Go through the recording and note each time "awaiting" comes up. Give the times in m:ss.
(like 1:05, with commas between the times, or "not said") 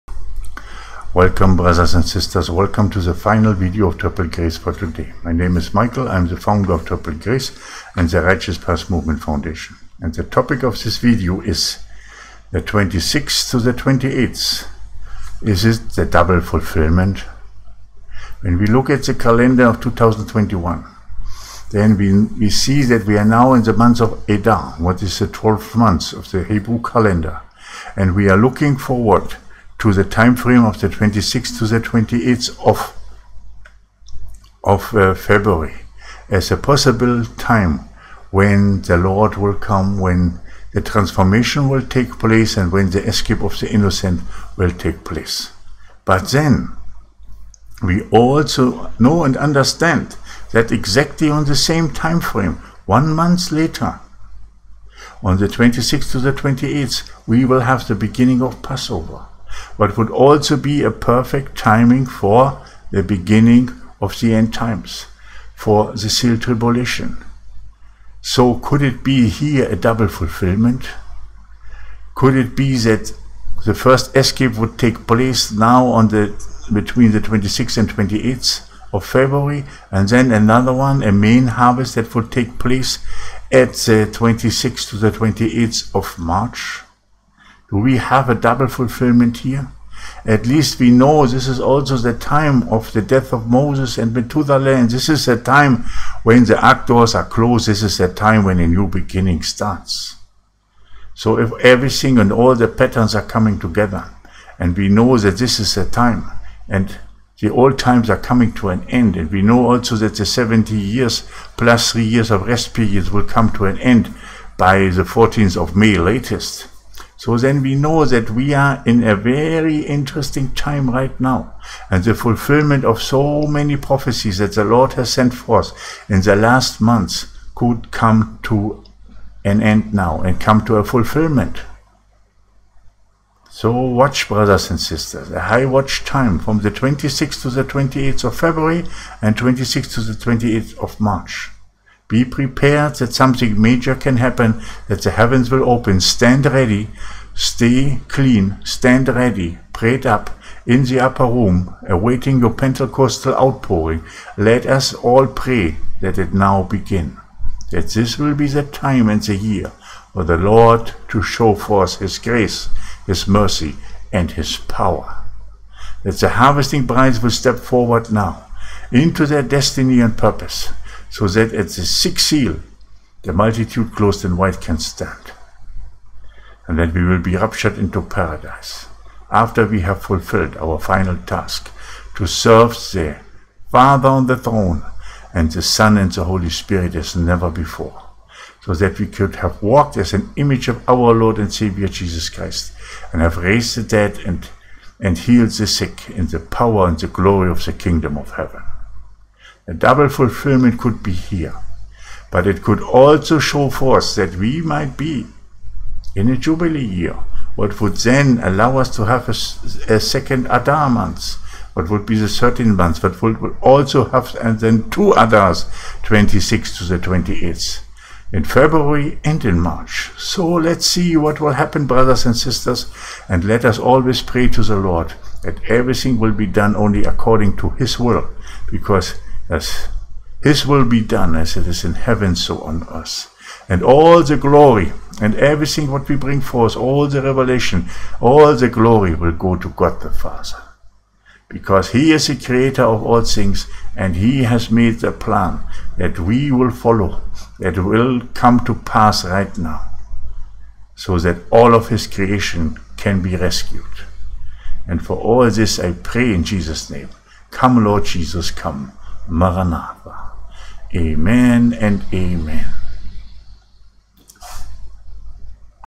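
2:31.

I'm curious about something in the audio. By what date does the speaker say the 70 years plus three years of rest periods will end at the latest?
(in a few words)
14th of May.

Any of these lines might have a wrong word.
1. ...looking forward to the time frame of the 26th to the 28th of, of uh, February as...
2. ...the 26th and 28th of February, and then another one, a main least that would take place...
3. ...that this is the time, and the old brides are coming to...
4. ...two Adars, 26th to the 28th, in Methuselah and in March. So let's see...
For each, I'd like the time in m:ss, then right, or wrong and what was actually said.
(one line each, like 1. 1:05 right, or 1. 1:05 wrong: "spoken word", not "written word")
1. 0:28 right
2. 1:17 wrong: "harvest", not "least"
3. 1:45 wrong: "times", not "brides"
4. 3:34 wrong: "February", not "Methuselah".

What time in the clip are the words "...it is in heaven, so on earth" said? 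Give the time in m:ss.
3:51.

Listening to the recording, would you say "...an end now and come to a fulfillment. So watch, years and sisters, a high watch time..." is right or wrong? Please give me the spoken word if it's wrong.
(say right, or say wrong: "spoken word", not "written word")
wrong: "brothers", not "years".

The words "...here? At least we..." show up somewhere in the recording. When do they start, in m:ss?
1:29.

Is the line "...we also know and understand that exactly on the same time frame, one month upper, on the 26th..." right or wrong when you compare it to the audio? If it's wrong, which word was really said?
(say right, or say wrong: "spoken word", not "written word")
wrong: "later", not "upper".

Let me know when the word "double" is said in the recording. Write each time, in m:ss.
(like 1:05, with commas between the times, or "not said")
0:16, 1:09, 1:28, 3:19.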